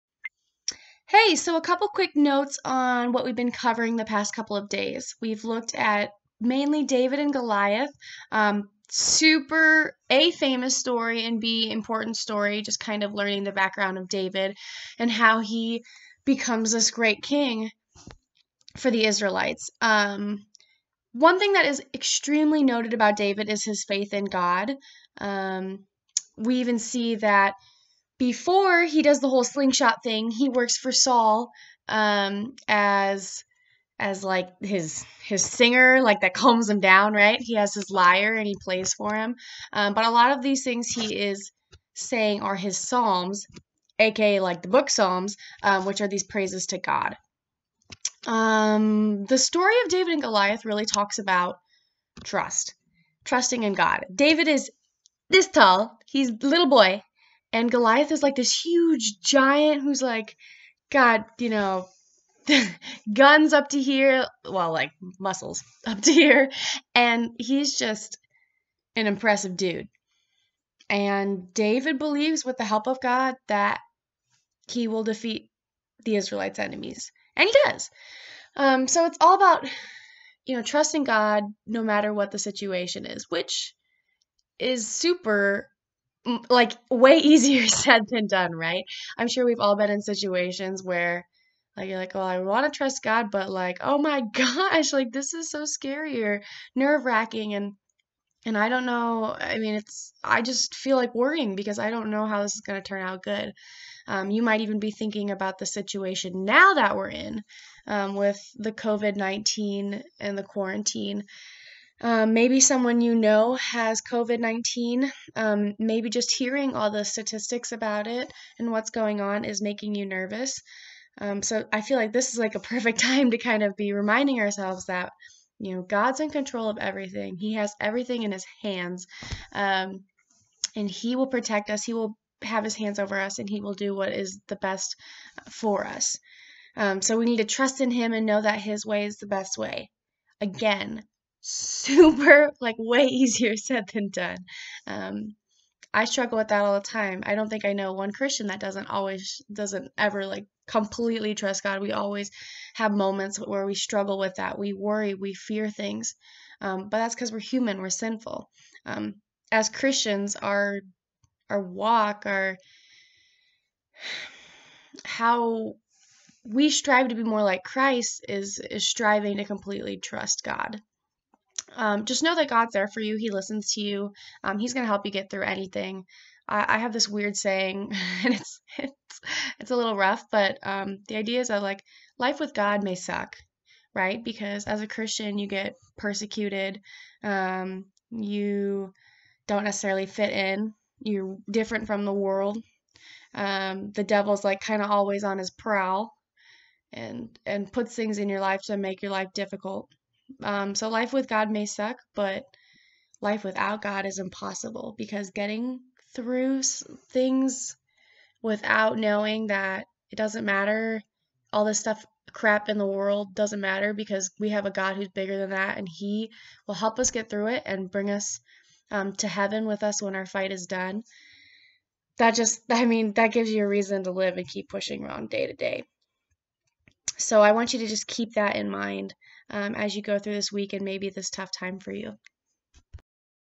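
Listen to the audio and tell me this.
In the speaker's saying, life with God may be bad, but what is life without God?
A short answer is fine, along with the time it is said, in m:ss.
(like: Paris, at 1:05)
impossible, at 3:24.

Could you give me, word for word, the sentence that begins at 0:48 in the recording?
Um, the story of David and Goliath really talks about trust, trusting in God.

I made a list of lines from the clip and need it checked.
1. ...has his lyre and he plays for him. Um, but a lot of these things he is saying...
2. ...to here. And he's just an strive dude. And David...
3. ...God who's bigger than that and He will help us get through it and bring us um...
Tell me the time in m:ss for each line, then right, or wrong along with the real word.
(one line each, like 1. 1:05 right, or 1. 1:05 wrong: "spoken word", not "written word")
1. 0:37 right
2. 1:06 wrong: "impressive", not "strive"
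3. 3:34 right.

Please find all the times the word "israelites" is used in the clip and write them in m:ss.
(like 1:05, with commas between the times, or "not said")
0:19, 1:16.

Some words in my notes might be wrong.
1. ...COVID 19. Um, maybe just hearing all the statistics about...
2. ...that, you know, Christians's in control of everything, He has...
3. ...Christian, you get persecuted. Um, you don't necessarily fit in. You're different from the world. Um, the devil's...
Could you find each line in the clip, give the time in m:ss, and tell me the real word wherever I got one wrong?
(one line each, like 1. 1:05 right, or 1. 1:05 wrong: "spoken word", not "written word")
1. 1:54 right
2. 2:04 wrong: "God", not "Christians"
3. 3:04 right.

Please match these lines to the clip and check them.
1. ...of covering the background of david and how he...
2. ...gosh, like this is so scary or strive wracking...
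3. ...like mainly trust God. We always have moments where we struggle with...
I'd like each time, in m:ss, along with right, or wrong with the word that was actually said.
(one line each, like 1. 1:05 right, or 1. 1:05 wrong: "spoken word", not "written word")
1. 0:13 wrong: "learning", not "covering"
2. 1:34 wrong: "nerve", not "strive"
3. 2:30 wrong: "completely", not "mainly".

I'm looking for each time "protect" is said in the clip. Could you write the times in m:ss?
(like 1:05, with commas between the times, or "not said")
2:11.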